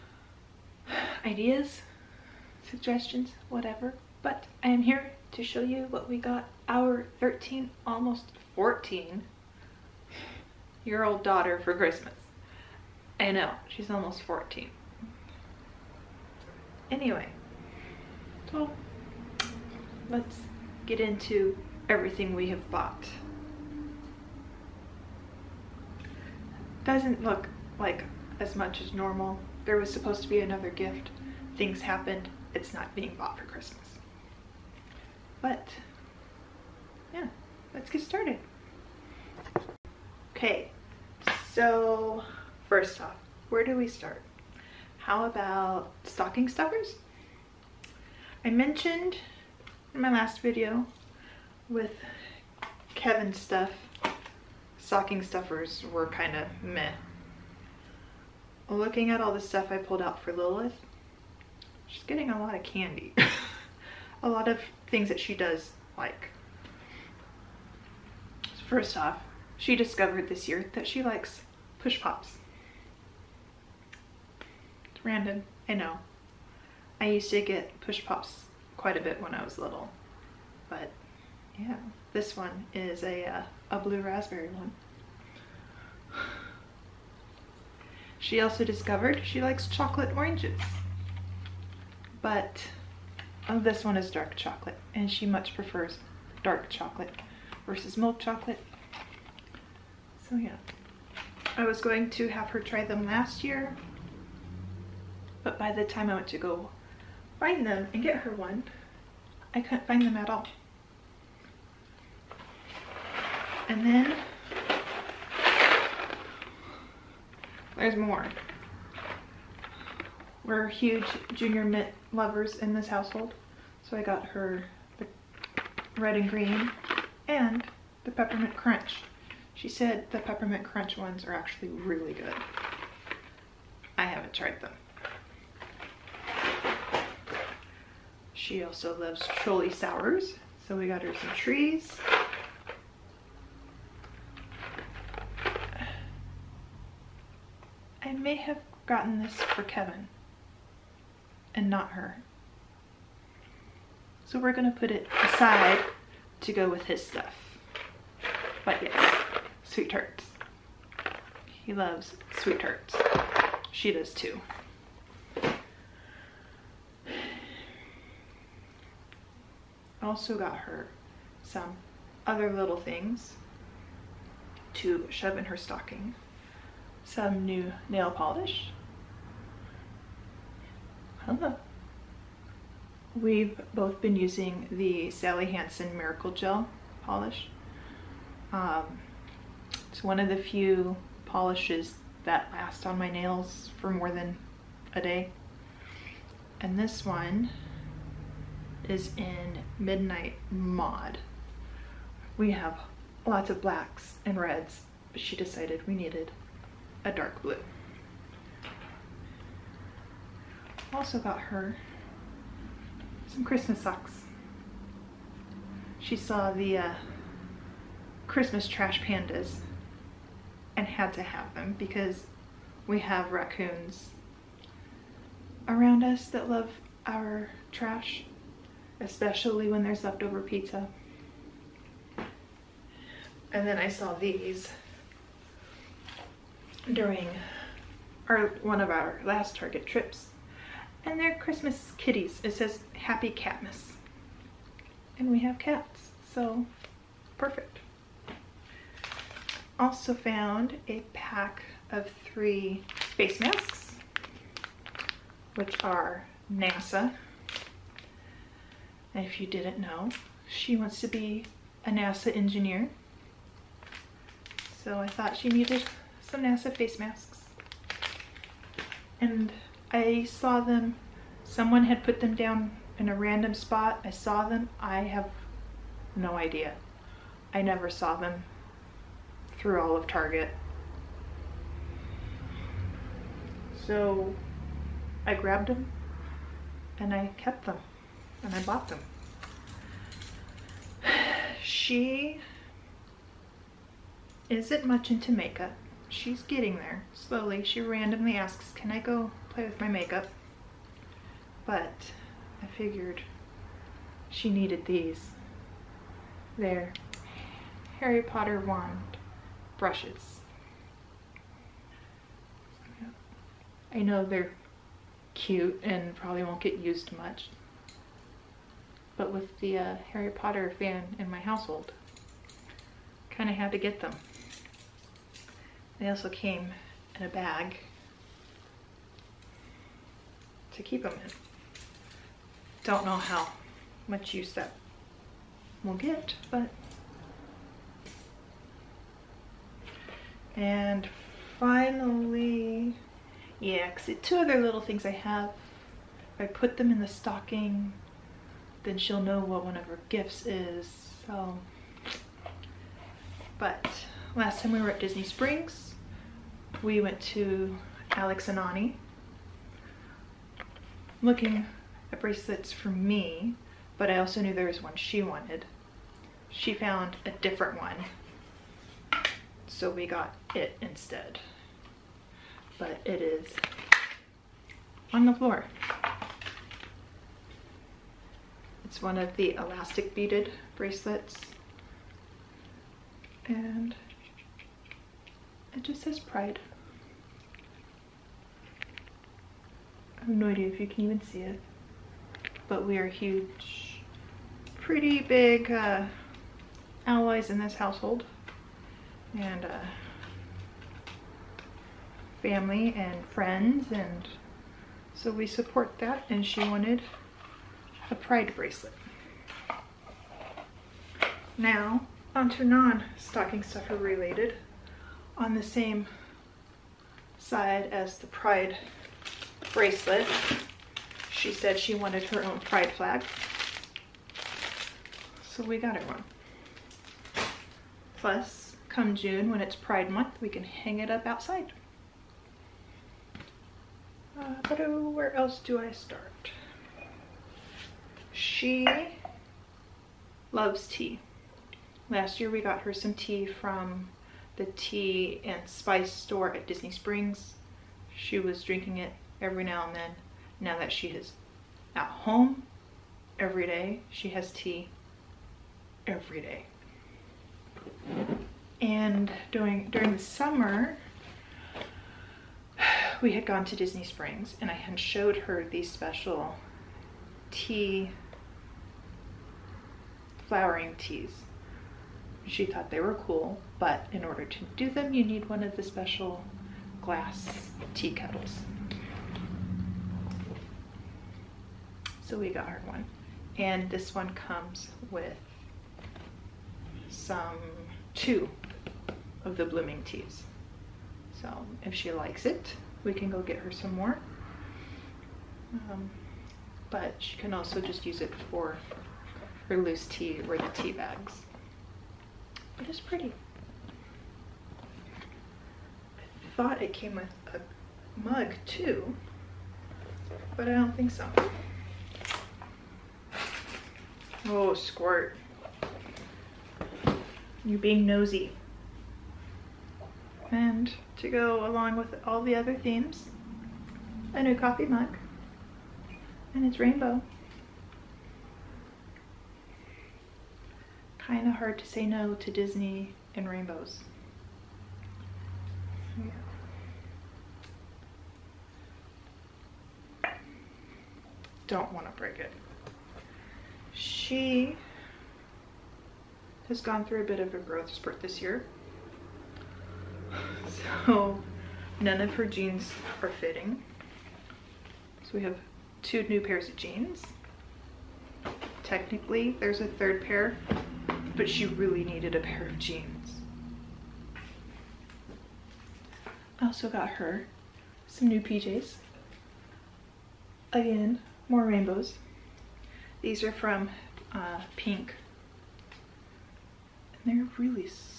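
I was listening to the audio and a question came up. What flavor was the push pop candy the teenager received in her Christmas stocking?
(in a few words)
Blue raspberry.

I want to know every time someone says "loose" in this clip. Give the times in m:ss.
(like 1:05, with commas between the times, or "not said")
8:19.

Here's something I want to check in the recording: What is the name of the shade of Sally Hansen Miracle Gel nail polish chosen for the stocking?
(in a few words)
Midnight Mod.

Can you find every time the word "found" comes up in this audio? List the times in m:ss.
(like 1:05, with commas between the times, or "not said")
4:10, 6:06.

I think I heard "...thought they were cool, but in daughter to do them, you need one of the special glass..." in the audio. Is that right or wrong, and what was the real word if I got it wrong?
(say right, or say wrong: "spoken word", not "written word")
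wrong: "order", not "daughter".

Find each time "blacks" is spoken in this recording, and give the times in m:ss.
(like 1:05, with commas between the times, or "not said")
3:23.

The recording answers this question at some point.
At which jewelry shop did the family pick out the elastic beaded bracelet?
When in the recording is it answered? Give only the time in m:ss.
5:58.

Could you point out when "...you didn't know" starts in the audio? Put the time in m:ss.
4:19.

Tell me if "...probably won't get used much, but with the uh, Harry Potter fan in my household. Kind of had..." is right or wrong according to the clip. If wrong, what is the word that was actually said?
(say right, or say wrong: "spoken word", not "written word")
right.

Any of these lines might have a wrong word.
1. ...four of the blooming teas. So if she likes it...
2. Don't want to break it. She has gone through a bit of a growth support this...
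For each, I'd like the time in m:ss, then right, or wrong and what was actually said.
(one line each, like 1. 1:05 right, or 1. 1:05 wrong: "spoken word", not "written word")
1. 8:08 wrong: "two", not "four"
2. 9:01 wrong: "spurt", not "support".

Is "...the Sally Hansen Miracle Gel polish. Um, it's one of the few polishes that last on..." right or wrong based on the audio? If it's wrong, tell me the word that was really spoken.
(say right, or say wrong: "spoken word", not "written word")
right.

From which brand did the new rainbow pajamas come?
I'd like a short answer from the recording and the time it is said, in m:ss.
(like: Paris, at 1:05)
Pink, at 9:34.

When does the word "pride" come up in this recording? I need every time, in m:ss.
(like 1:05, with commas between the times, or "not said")
6:26, 6:48, 6:58, 7:02, 7:09.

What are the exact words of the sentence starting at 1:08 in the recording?
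First off, she discovered this year that she likes push pops.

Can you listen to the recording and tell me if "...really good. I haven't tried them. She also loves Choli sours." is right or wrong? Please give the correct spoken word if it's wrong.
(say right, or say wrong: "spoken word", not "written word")
right.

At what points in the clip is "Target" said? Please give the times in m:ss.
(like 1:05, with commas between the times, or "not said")
3:59, 4:40.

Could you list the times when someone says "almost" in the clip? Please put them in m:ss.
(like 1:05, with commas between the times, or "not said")
0:07, 0:13.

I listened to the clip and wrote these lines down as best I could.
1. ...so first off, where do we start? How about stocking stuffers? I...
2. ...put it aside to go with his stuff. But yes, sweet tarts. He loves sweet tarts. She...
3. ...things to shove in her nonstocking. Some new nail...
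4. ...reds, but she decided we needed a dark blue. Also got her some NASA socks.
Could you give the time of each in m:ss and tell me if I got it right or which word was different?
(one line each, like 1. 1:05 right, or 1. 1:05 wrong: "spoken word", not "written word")
1. 0:41 right
2. 2:34 right
3. 2:52 wrong: "stocking", not "nonstocking"
4. 3:24 wrong: "Christmas", not "NASA".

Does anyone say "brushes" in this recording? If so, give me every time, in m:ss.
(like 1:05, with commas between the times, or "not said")
5:09.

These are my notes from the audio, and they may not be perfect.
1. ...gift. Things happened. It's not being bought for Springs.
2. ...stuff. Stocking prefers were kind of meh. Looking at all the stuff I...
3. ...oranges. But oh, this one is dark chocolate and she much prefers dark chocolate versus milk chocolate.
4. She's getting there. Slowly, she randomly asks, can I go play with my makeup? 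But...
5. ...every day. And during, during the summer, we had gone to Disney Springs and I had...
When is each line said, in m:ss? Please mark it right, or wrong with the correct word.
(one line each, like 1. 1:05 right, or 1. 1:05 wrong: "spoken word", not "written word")
1. 0:30 wrong: "Christmas", not "Springs"
2. 0:53 wrong: "stuffers", not "prefers"
3. 1:30 right
4. 4:56 right
5. 7:36 right.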